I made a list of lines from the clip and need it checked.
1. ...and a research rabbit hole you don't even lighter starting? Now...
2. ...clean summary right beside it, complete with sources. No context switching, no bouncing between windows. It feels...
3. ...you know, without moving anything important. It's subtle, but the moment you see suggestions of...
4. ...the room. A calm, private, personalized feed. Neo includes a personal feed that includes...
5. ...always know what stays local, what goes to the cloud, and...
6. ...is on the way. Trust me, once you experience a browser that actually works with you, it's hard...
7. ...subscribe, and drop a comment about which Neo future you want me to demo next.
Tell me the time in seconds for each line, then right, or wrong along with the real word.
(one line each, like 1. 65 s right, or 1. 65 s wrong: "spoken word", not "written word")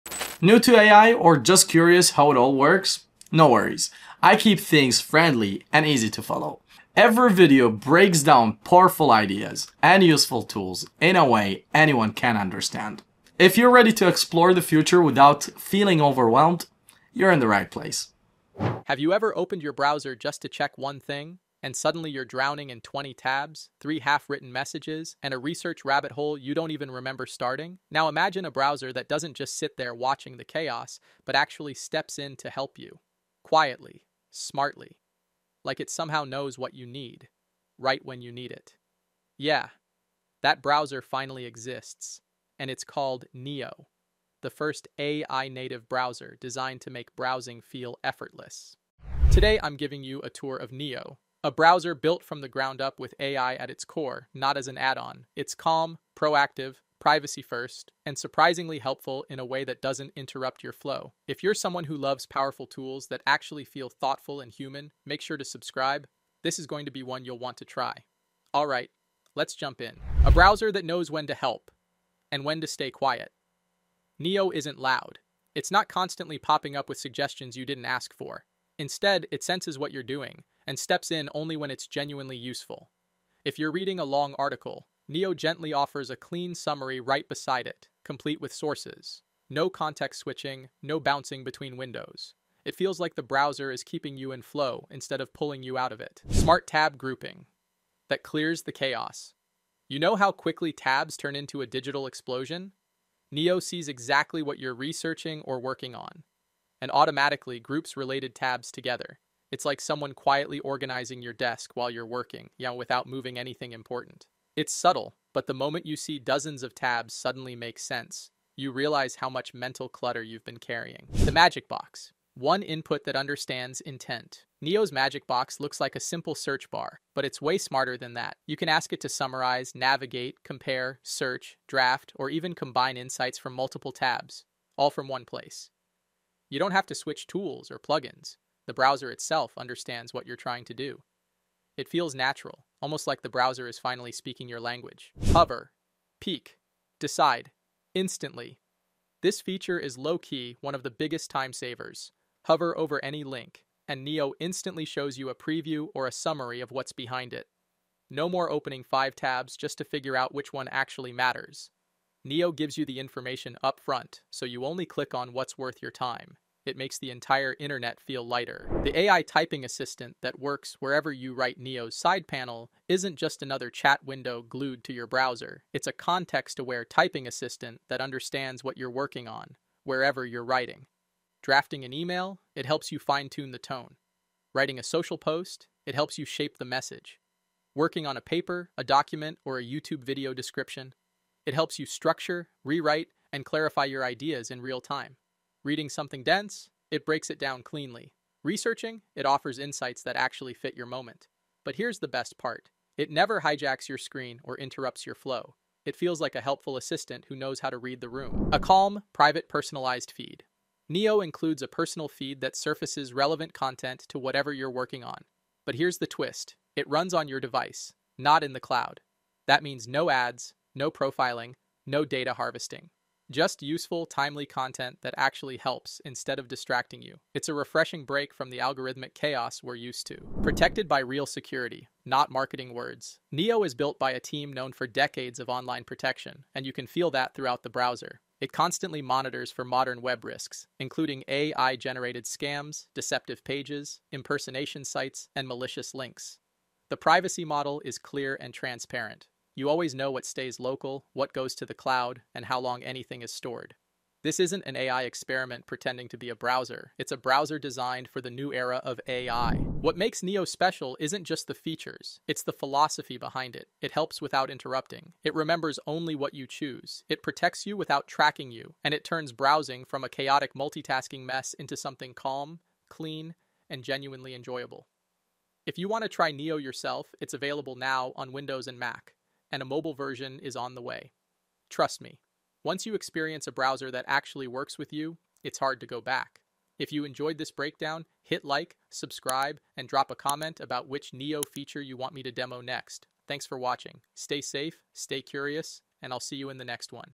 1. 25 s wrong: "remember", not "lighter"
2. 86 s right
3. 112 s wrong: "dozens", not "suggestions"
4. 208 s wrong: "surfaces", not "includes"
5. 249 s right
6. 280 s right
7. 288 s wrong: "feature", not "future".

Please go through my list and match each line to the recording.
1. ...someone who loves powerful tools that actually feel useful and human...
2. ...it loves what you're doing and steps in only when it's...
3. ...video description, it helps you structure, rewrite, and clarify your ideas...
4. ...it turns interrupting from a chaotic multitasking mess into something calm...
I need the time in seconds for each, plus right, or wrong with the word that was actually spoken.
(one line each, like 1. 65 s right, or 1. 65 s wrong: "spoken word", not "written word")
1. 61 s wrong: "thoughtful", not "useful"
2. 79 s wrong: "senses", not "loves"
3. 190 s right
4. 268 s wrong: "browsing", not "interrupting".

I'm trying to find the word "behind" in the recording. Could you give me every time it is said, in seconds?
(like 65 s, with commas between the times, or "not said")
156 s, 263 s.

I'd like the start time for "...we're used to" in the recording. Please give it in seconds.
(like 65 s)
229 s.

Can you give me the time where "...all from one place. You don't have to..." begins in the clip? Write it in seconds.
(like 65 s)
134 s.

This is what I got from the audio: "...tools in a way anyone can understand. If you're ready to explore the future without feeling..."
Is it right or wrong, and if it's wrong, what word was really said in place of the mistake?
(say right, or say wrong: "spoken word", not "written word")
right.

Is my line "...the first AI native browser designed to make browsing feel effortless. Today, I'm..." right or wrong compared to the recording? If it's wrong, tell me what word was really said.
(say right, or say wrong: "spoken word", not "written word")
right.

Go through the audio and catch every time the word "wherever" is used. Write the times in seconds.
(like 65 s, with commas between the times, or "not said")
170 s, 179 s.